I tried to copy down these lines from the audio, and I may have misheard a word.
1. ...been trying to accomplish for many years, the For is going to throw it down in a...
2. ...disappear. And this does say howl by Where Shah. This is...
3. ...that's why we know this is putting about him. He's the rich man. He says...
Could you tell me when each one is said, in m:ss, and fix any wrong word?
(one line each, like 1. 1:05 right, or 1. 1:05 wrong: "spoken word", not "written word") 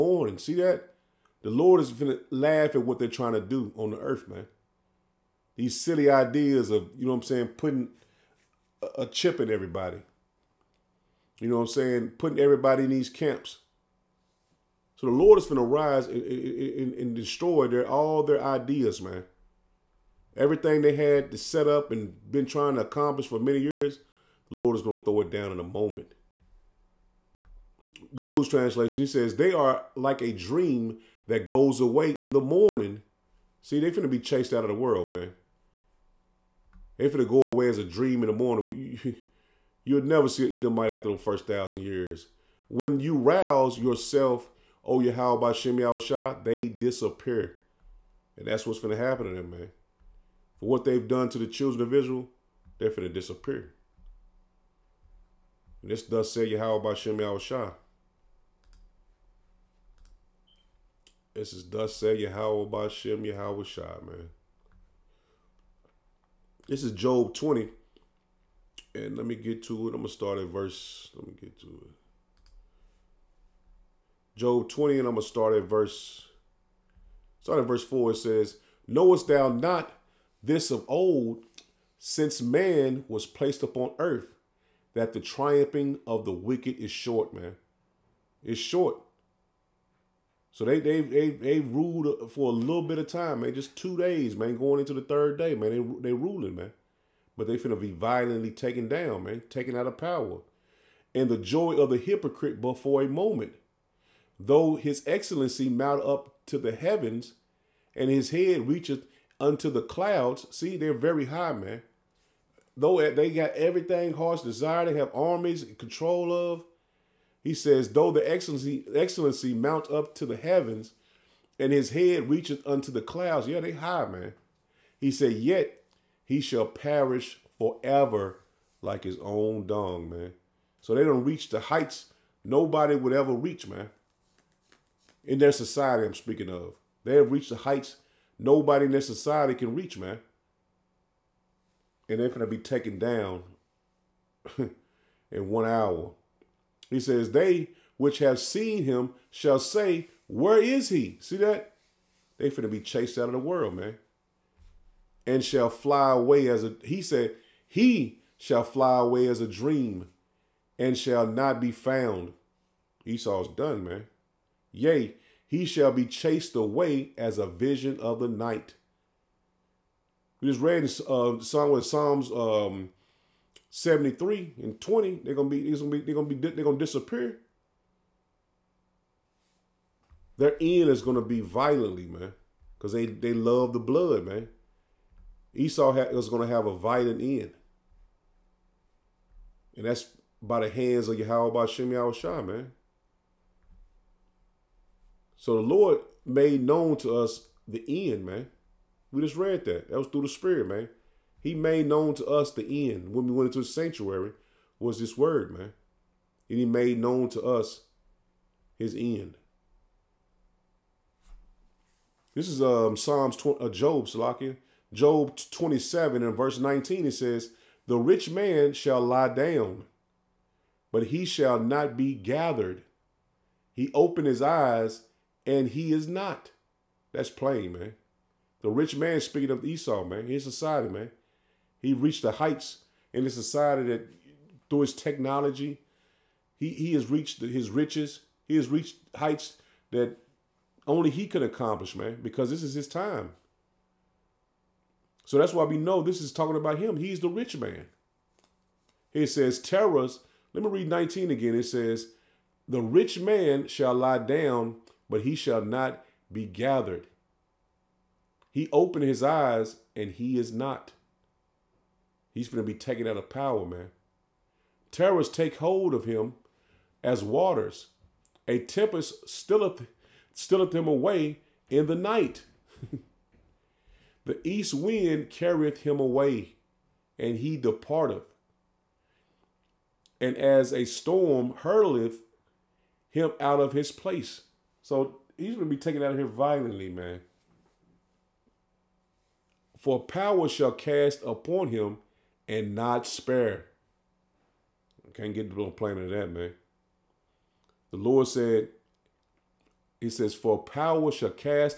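1. 0:22 wrong: "Lord", not "For"
2. 0:53 wrong: "Shimei", not "Where"
3. 4:05 wrong: "talking", not "putting".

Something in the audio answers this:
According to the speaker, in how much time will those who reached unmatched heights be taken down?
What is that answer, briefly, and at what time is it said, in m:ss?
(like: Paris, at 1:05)
One hour, at 2:25.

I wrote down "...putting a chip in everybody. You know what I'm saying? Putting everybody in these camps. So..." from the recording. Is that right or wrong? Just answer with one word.
right.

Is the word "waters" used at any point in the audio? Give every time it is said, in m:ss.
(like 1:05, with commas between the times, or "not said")
4:27.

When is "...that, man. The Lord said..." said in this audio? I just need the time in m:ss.
4:56.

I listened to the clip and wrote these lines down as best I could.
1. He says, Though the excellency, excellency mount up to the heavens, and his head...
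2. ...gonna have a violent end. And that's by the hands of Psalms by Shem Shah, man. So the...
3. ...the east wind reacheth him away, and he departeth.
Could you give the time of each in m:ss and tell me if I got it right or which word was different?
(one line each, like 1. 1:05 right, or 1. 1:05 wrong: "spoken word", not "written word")
1. 1:57 right
2. 3:06 wrong: "Yahweh", not "Psalms"
3. 4:34 wrong: "carrieth", not "reacheth".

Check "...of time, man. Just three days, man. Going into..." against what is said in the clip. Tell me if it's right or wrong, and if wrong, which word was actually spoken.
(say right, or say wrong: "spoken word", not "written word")
wrong: "two", not "three".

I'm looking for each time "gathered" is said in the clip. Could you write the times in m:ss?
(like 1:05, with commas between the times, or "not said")
3:42, 4:16.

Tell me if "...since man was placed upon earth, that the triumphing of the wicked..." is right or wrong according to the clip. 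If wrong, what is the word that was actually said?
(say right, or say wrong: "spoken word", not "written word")
right.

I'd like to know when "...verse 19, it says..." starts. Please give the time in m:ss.
3:36.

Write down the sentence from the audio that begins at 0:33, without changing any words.
See, they're going to be chased out of the world, man.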